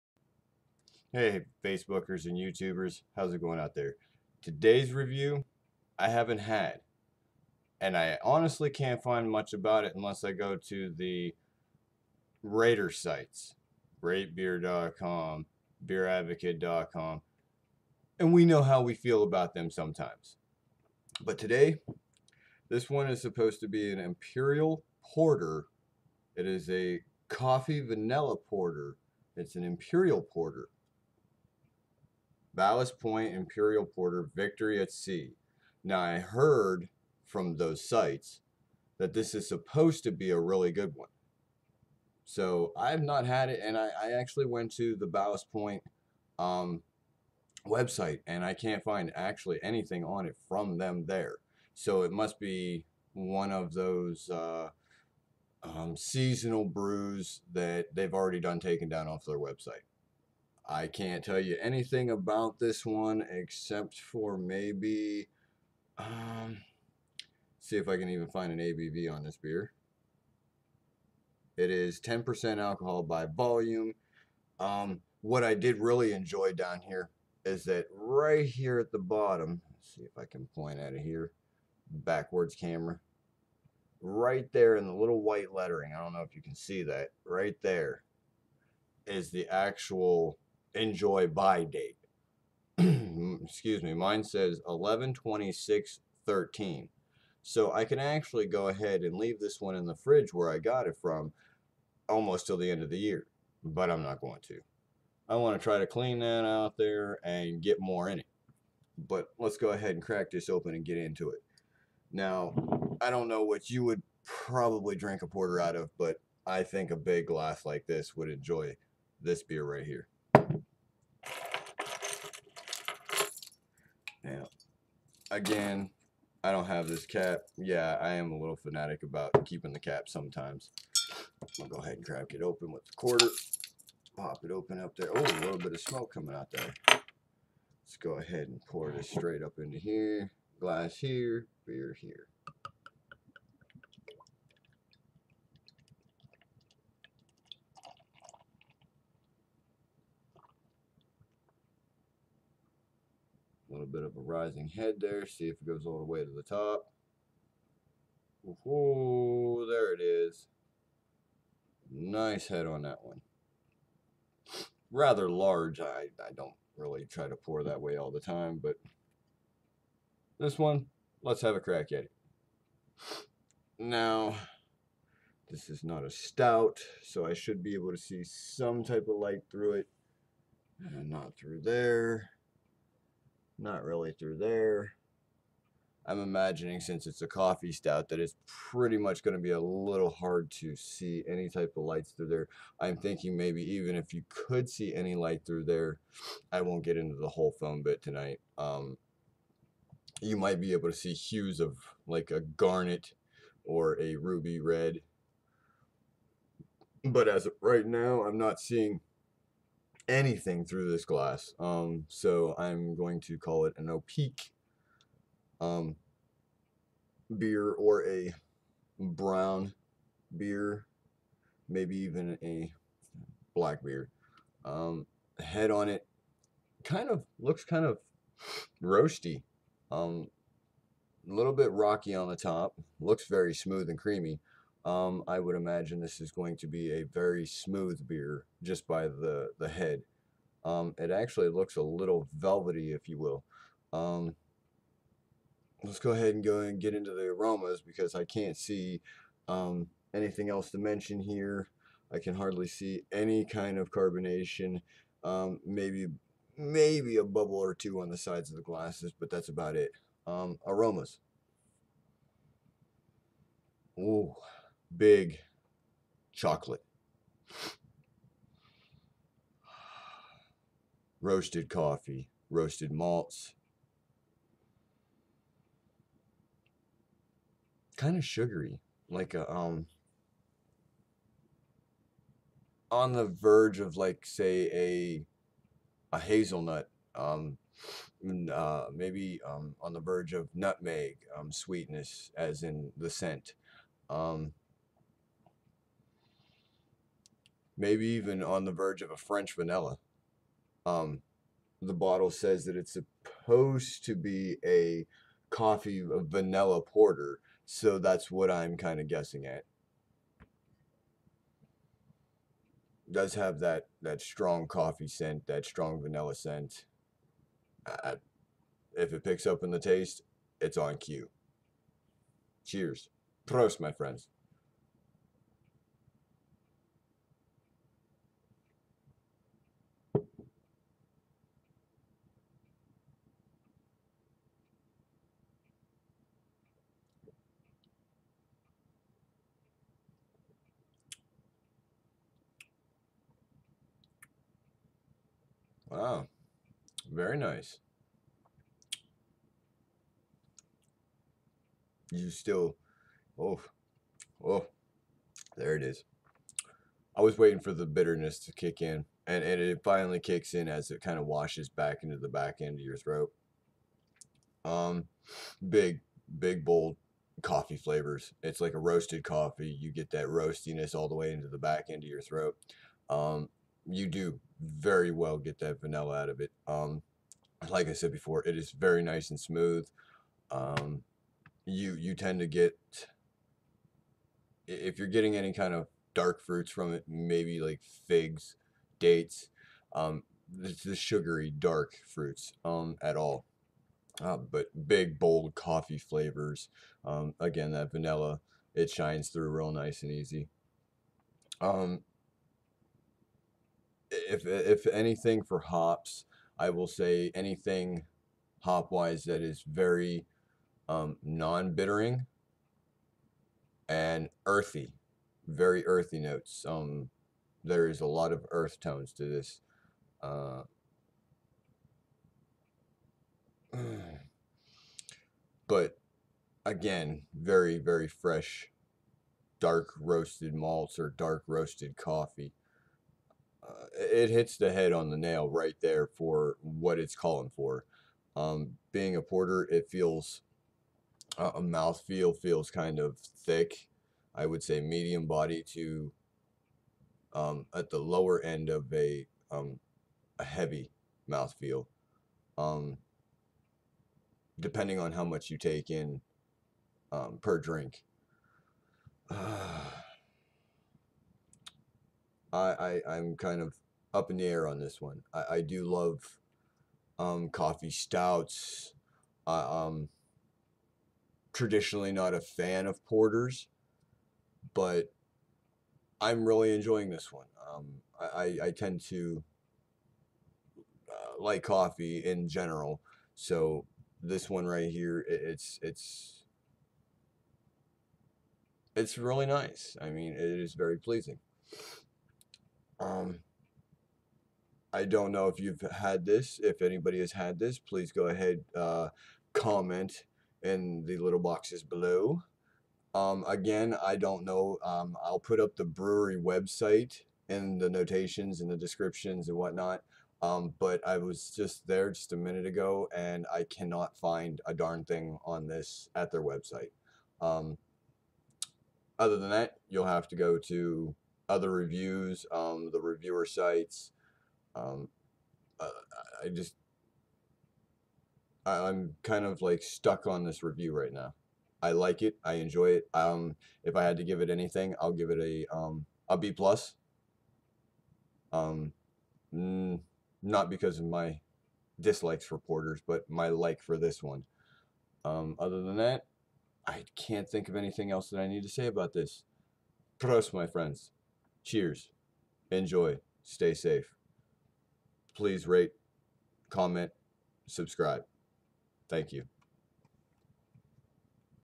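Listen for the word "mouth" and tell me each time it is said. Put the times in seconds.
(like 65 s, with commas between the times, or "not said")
441 s, 451 s.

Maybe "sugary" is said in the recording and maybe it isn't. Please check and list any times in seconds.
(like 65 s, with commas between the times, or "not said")
278 s, 390 s.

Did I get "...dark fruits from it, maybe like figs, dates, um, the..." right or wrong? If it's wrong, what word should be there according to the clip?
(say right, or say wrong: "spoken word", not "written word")
right.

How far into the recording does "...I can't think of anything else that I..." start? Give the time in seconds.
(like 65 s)
546 s.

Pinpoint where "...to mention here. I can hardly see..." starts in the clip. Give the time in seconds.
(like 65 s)
250 s.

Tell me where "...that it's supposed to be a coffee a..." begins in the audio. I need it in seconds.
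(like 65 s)
302 s.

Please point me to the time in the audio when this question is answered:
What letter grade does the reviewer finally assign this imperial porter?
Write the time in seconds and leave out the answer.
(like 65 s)
536 s.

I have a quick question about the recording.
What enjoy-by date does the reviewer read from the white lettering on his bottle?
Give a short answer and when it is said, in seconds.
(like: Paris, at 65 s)
11/26/13, at 94 s.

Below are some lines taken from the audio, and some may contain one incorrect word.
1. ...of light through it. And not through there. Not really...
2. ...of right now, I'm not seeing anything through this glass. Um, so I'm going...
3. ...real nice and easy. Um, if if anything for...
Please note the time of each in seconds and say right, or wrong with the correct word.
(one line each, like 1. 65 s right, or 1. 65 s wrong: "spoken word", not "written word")
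1. 179 s right
2. 207 s right
3. 399 s right.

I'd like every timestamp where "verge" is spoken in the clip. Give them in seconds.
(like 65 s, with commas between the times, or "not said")
283 s, 289 s, 298 s.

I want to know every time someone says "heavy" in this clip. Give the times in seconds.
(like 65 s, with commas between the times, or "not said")
450 s.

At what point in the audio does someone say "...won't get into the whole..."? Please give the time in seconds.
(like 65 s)
196 s.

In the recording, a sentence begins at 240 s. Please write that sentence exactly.
Um, it actually looks a little velvety, if you will.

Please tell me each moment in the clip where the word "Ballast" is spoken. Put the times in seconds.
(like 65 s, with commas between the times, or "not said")
32 s, 45 s.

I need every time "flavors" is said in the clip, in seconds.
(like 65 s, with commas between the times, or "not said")
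367 s, 395 s.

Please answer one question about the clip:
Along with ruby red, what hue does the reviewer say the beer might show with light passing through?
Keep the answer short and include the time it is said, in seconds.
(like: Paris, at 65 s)
garnet, at 202 s.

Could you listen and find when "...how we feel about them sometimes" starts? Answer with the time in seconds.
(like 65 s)
18 s.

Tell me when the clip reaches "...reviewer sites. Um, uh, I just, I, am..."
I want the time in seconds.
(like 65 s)
523 s.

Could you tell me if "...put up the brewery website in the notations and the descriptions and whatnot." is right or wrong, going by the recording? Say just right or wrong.
right.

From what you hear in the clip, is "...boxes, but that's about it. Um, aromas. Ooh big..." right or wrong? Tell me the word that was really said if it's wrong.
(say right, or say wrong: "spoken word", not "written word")
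wrong: "glasses", not "boxes".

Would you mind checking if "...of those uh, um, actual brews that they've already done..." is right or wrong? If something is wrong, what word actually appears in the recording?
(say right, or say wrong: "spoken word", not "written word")
wrong: "seasonal", not "actual".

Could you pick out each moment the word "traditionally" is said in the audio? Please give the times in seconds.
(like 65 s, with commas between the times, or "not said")
471 s.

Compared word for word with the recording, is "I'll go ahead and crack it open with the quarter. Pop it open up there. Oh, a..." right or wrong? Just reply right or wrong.
right.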